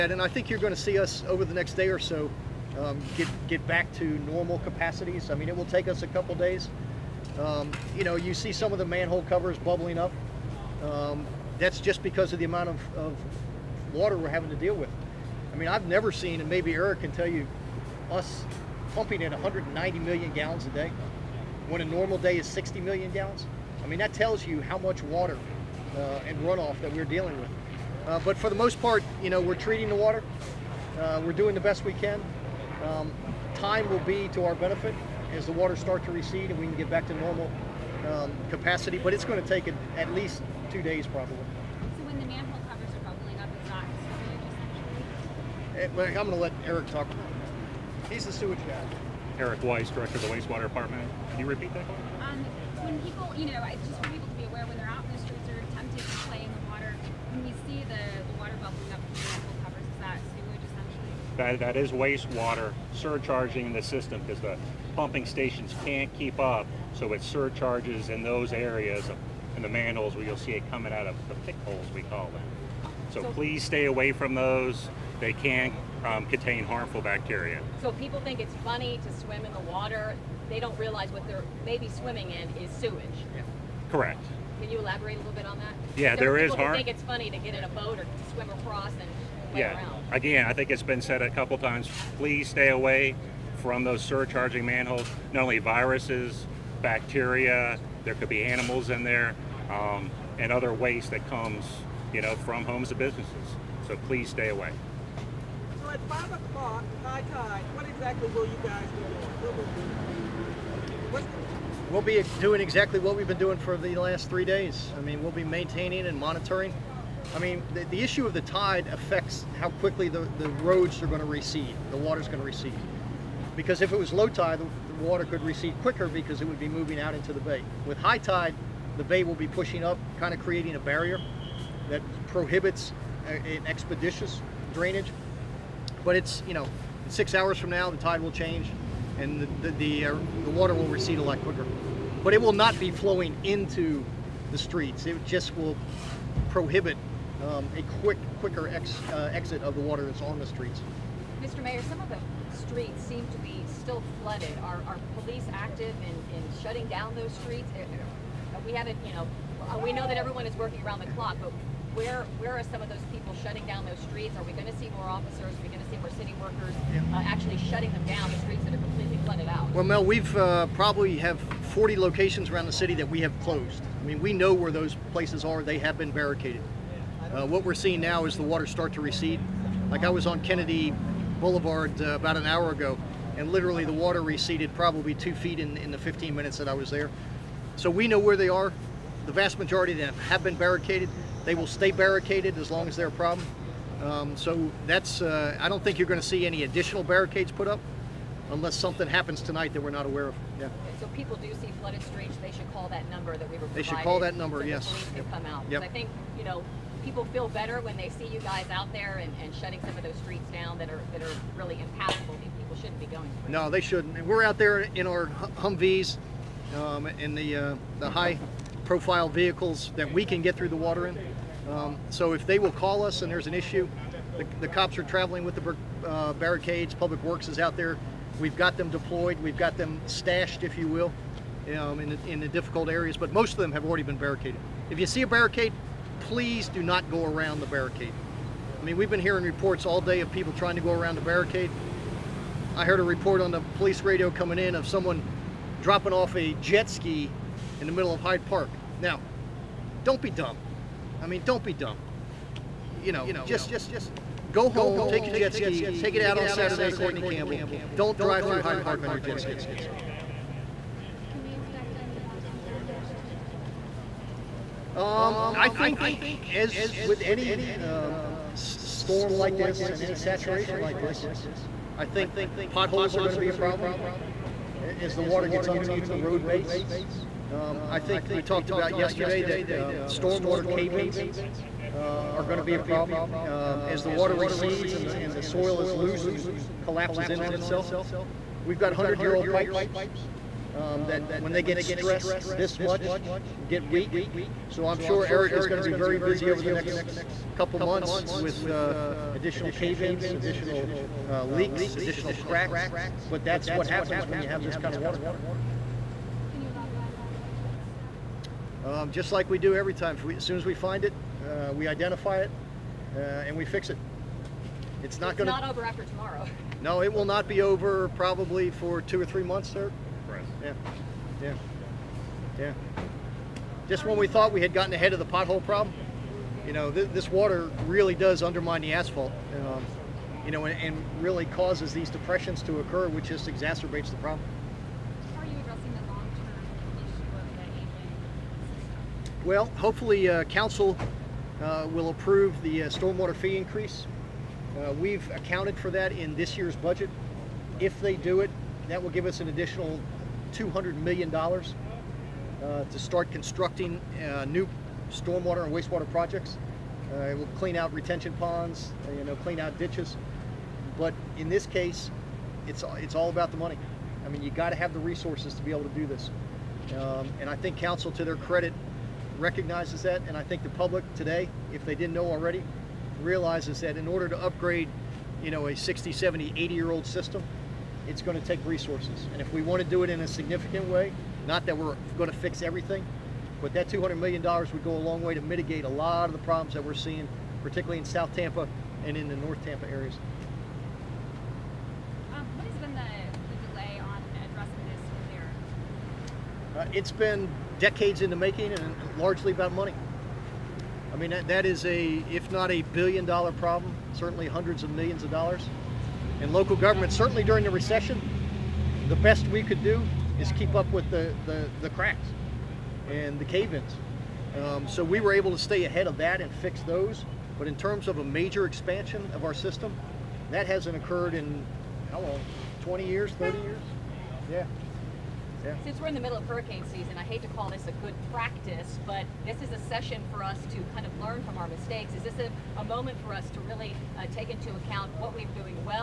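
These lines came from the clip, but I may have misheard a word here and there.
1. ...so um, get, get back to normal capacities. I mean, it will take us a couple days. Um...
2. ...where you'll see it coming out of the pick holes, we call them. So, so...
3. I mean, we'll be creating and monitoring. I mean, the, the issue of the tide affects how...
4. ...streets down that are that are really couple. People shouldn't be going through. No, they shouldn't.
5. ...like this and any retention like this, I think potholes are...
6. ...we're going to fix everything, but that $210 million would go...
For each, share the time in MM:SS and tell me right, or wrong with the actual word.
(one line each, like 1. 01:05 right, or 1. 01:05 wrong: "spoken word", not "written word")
1. 00:01 right
2. 01:10 right
3. 01:54 wrong: "maintaining", not "creating"
4. 03:30 wrong: "impassable", not "couple"
5. 04:29 wrong: "saturation", not "retention"
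6. 06:21 wrong: "200", not "210".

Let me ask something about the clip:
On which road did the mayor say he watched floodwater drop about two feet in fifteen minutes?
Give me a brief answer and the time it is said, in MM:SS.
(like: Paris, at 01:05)
Kennedy Boulevard, at 03:00.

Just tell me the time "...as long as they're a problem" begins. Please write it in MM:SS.
03:12.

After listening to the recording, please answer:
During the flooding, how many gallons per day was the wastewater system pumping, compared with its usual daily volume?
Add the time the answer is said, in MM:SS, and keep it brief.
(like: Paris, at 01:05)
190 million gallons, at 00:19.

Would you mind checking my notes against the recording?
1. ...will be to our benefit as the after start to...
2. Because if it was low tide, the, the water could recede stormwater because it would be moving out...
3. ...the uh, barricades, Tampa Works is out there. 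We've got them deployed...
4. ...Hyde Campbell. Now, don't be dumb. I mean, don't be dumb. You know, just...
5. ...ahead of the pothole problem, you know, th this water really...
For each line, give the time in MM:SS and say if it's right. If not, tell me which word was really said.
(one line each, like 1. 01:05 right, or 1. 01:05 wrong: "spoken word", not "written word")
1. 00:33 wrong: "water", not "after"
2. 02:03 wrong: "quicker", not "stormwater"
3. 03:45 wrong: "Public", not "Tampa"
4. 04:08 wrong: "Park", not "Campbell"
5. 05:24 right.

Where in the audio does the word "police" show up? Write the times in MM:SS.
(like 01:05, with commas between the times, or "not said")
02:35, 03:24, 04:03.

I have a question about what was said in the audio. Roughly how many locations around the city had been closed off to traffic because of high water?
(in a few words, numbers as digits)
40.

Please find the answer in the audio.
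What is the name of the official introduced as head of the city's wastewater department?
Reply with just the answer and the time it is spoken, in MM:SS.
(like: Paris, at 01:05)
Eric Weiss, at 00:49.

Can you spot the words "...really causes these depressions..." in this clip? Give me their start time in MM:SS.
05:31.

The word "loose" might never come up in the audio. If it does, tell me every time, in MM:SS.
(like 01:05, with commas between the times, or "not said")
04:45.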